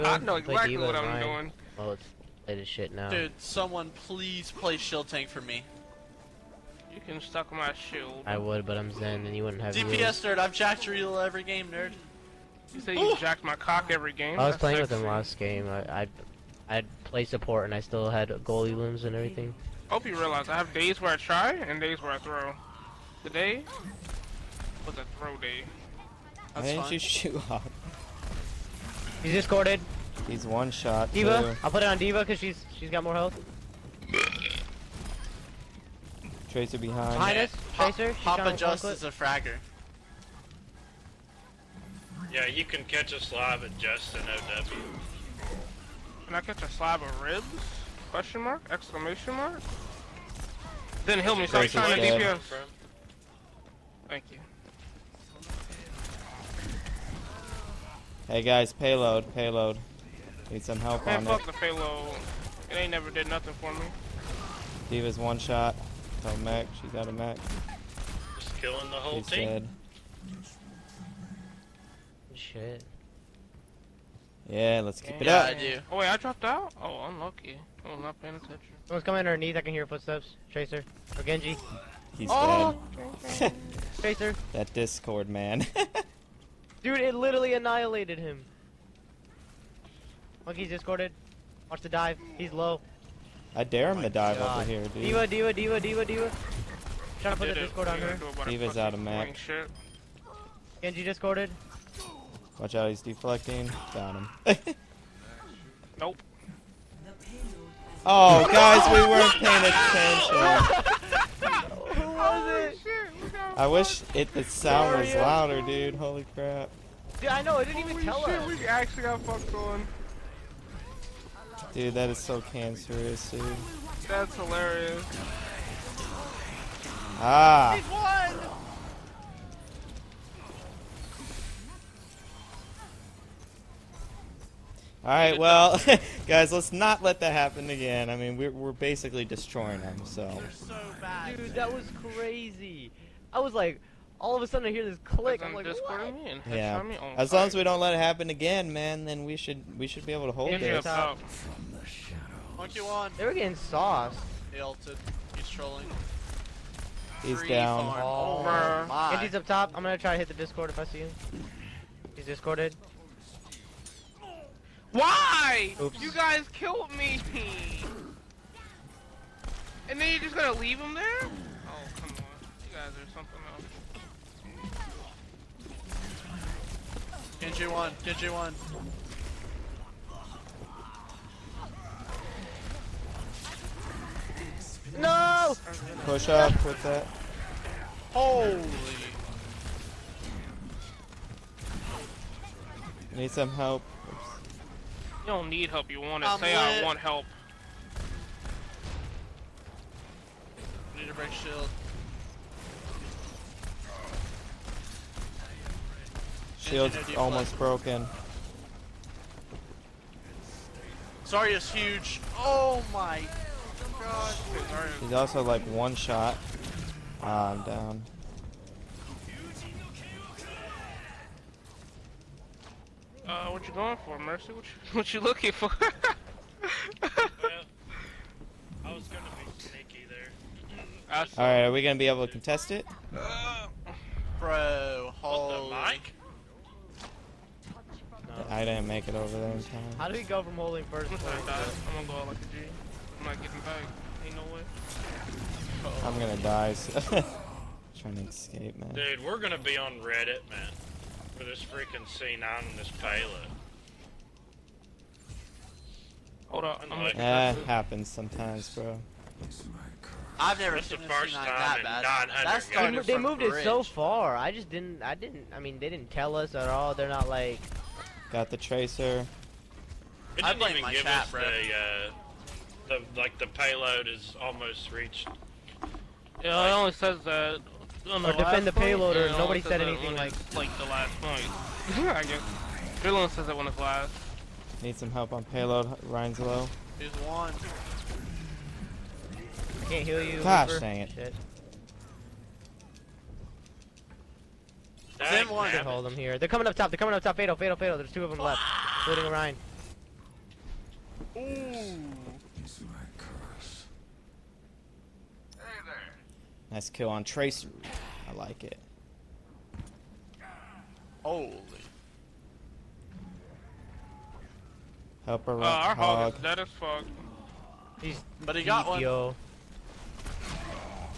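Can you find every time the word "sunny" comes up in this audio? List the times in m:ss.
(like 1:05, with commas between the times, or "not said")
not said.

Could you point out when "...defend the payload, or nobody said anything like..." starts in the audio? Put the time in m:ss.
4:38.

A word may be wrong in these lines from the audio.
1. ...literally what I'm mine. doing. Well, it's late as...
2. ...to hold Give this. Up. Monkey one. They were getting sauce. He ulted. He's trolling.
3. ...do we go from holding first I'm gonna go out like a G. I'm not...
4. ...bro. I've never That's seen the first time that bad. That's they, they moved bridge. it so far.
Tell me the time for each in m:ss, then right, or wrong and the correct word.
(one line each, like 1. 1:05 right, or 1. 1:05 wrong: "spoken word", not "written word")
1. 0:00 wrong: "exactly", not "literally"
2. 2:30 right
3. 4:00 right
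4. 4:18 right.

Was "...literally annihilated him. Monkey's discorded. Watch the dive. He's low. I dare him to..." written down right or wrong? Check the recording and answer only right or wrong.
right.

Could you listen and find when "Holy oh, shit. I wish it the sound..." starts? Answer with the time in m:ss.
1:52.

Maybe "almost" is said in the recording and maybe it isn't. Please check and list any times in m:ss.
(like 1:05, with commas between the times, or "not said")
3:27, 4:34.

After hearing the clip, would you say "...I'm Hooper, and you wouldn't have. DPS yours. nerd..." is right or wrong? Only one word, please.
wrong.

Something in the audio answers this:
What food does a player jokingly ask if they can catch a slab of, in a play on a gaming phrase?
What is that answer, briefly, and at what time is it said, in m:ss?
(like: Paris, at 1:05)
Ribs, at 0:46.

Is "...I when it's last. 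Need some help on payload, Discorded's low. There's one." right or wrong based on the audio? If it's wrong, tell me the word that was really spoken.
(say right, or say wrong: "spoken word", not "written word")
wrong: "Rein", not "Discorded".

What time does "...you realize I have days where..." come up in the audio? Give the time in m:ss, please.
0:20.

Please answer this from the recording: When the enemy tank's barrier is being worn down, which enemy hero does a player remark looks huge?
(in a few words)
Zarya.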